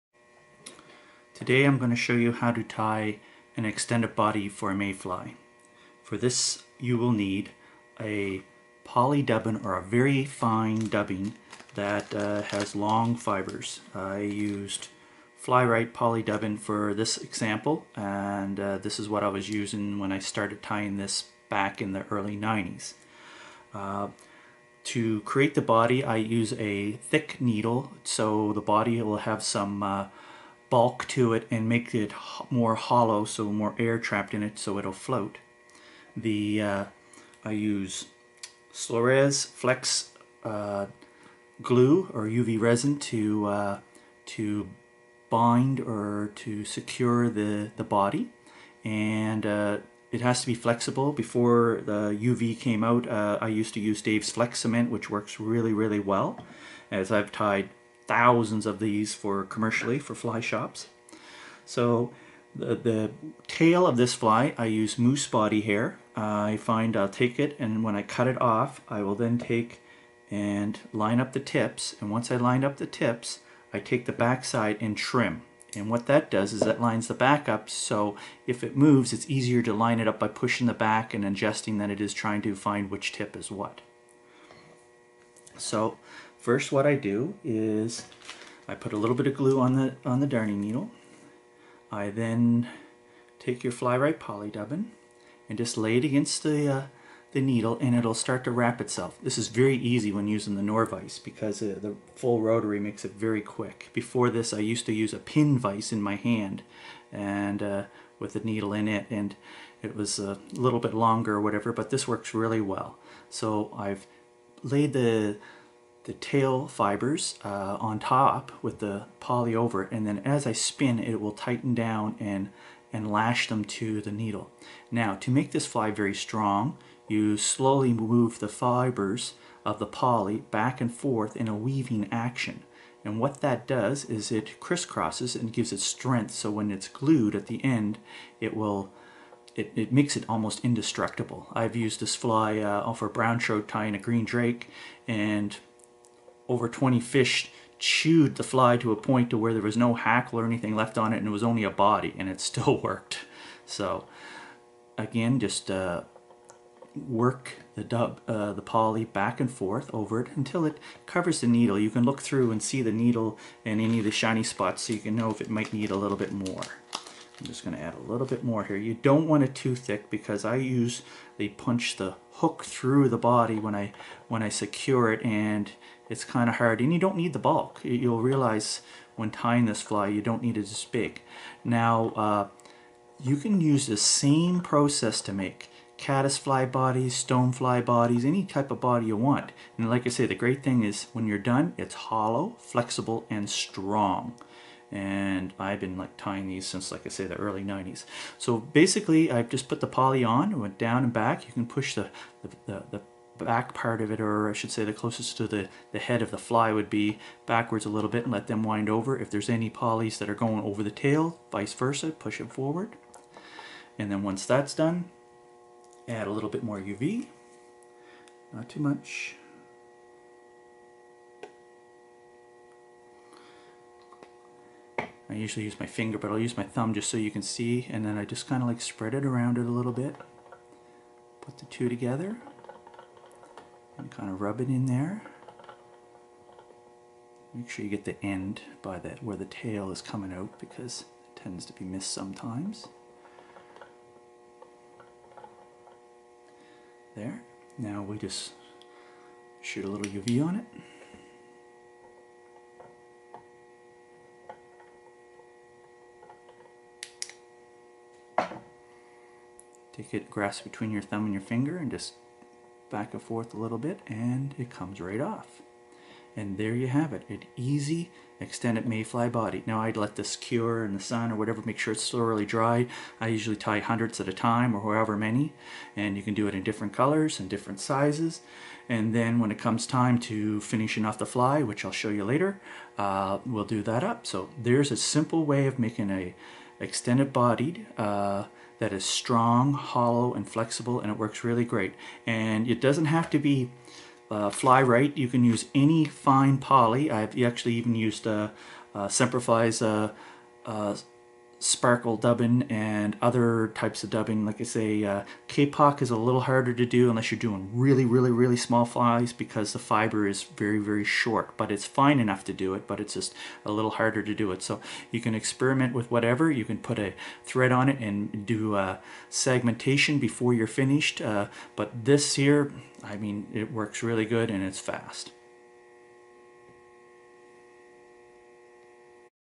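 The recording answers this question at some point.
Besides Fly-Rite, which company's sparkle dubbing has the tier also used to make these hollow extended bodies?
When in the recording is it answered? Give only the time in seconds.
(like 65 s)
299 s.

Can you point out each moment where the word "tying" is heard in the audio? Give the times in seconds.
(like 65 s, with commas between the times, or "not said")
20 s, 143 s, 179 s, 196 s.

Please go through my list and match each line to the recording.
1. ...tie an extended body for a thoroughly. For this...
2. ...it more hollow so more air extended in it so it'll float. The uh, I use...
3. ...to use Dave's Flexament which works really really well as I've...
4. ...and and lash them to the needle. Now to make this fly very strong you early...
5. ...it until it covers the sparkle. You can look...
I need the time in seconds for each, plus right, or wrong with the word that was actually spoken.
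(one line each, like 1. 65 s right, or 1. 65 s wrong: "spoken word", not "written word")
1. 2 s wrong: "mayfly", not "thoroughly"
2. 31 s wrong: "trapped", not "extended"
3. 53 s right
4. 122 s wrong: "slowly", not "early"
5. 160 s wrong: "needle", not "sparkle".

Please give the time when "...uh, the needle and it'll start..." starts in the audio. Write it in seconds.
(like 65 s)
96 s.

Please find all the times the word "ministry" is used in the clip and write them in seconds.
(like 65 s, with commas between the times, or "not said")
not said.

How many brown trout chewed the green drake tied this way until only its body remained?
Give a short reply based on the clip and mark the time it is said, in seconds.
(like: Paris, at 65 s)
Over 20, at 146 s.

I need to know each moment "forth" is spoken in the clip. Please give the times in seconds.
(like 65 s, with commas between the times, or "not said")
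130 s, 159 s, 263 s.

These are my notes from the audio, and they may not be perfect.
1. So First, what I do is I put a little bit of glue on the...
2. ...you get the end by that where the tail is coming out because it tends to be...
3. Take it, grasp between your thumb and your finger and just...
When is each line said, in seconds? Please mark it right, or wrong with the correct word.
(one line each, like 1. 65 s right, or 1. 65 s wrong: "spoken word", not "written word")
1. 85 s right
2. 237 s right
3. 259 s right.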